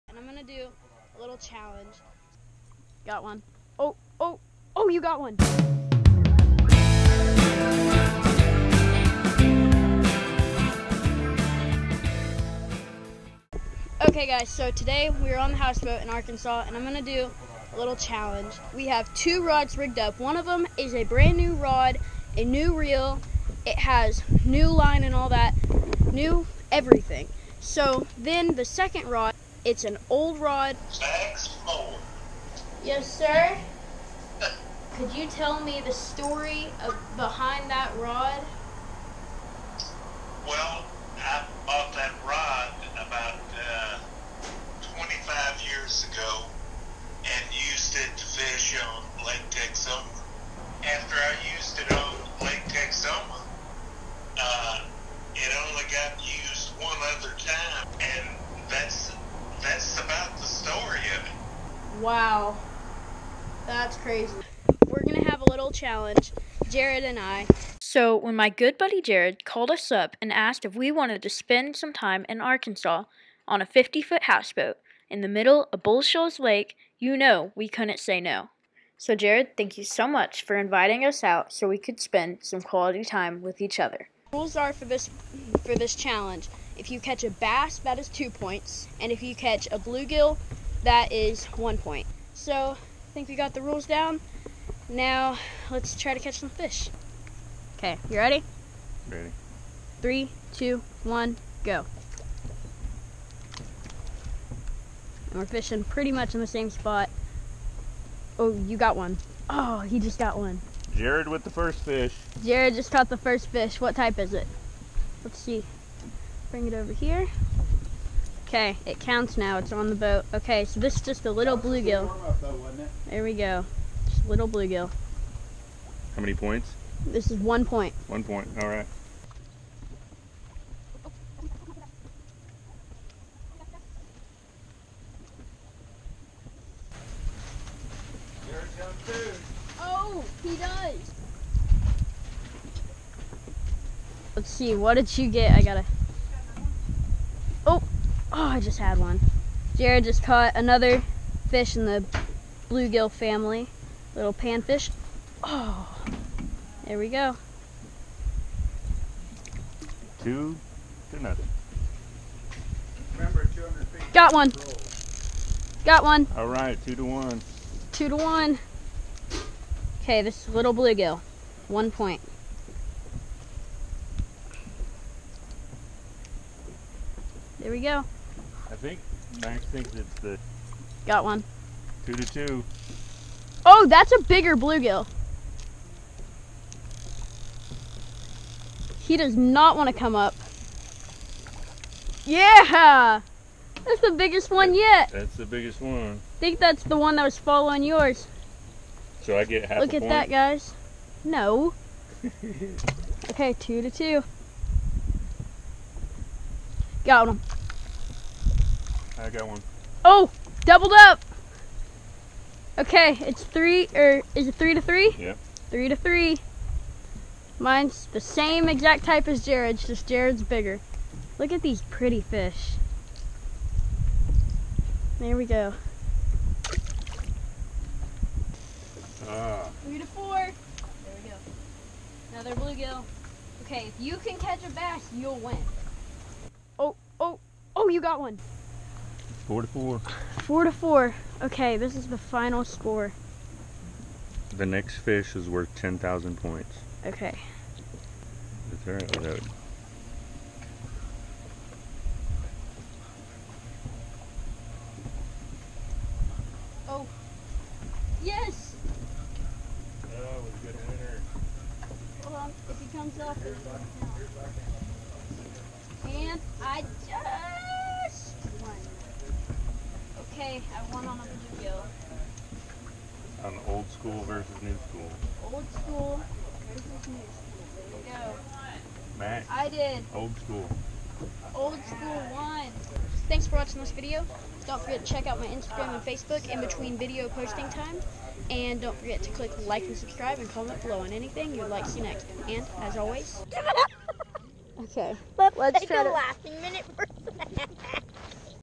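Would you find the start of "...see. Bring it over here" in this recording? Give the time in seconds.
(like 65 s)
115 s.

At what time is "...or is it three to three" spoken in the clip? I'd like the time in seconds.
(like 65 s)
213 s.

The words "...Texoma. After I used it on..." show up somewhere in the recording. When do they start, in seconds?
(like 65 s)
49 s.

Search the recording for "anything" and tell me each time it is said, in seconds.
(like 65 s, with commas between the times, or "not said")
291 s.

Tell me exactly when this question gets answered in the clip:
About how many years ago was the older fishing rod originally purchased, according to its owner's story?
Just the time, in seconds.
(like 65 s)
44 s.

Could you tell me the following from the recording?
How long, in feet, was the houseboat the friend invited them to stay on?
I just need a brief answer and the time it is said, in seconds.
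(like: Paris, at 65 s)
50, at 73 s.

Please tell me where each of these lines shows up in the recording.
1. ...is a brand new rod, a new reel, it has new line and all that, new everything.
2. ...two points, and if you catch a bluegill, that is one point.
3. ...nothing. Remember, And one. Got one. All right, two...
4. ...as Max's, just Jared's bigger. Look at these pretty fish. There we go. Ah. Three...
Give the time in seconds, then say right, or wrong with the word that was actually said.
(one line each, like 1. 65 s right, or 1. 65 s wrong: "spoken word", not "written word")
1. 20 s right
2. 88 s right
3. 161 s wrong: "Got", not "And"
4. 219 s wrong: "Jared", not "Max".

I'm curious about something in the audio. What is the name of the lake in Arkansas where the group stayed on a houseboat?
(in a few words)
Bull Shoals Lake.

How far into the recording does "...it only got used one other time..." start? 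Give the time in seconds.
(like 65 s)
55 s.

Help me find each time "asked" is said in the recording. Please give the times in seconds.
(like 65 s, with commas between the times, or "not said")
70 s.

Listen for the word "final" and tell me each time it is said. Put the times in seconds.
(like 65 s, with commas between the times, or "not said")
242 s.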